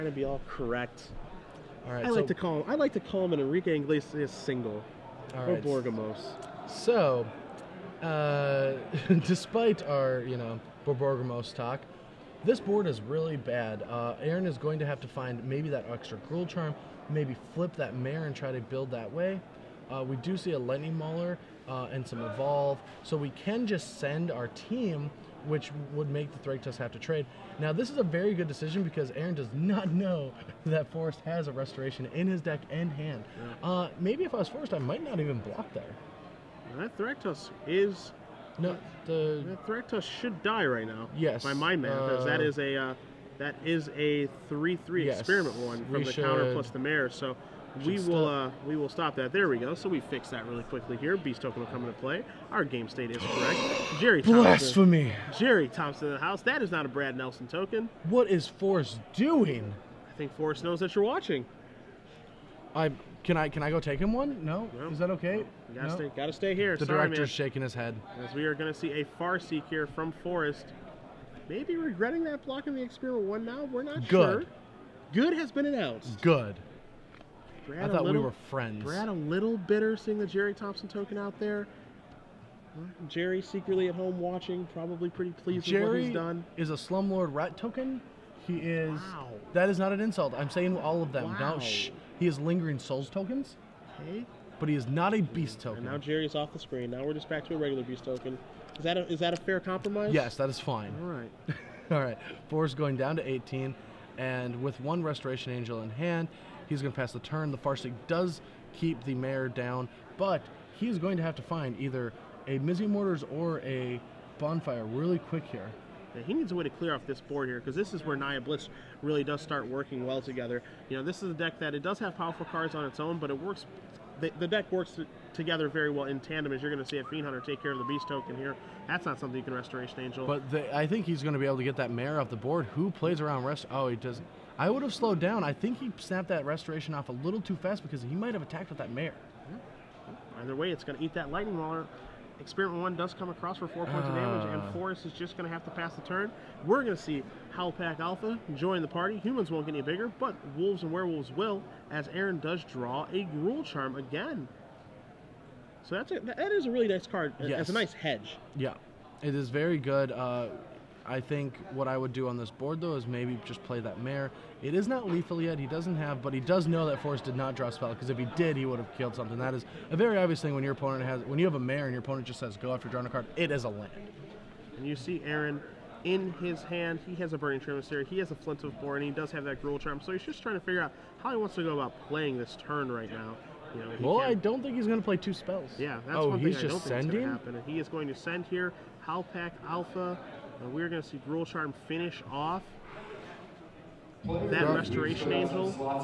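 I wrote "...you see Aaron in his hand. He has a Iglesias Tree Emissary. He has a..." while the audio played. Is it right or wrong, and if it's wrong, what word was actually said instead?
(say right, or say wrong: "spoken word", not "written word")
wrong: "Burning", not "Iglesias".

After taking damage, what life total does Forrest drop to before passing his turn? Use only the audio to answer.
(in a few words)
18.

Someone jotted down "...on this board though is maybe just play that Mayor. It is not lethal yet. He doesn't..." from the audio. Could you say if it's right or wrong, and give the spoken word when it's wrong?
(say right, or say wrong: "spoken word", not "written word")
right.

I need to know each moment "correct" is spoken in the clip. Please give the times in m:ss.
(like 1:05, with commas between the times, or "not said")
0:00, 0:53.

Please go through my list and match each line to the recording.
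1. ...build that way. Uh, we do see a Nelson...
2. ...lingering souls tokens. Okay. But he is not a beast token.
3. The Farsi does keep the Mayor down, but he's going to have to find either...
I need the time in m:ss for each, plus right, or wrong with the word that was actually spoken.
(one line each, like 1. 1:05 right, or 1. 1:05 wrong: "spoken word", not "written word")
1. 0:18 wrong: "Lenny", not "Nelson"
2. 1:32 right
3. 1:47 right.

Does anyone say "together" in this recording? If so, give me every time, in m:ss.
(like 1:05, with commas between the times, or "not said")
2:00, 2:05.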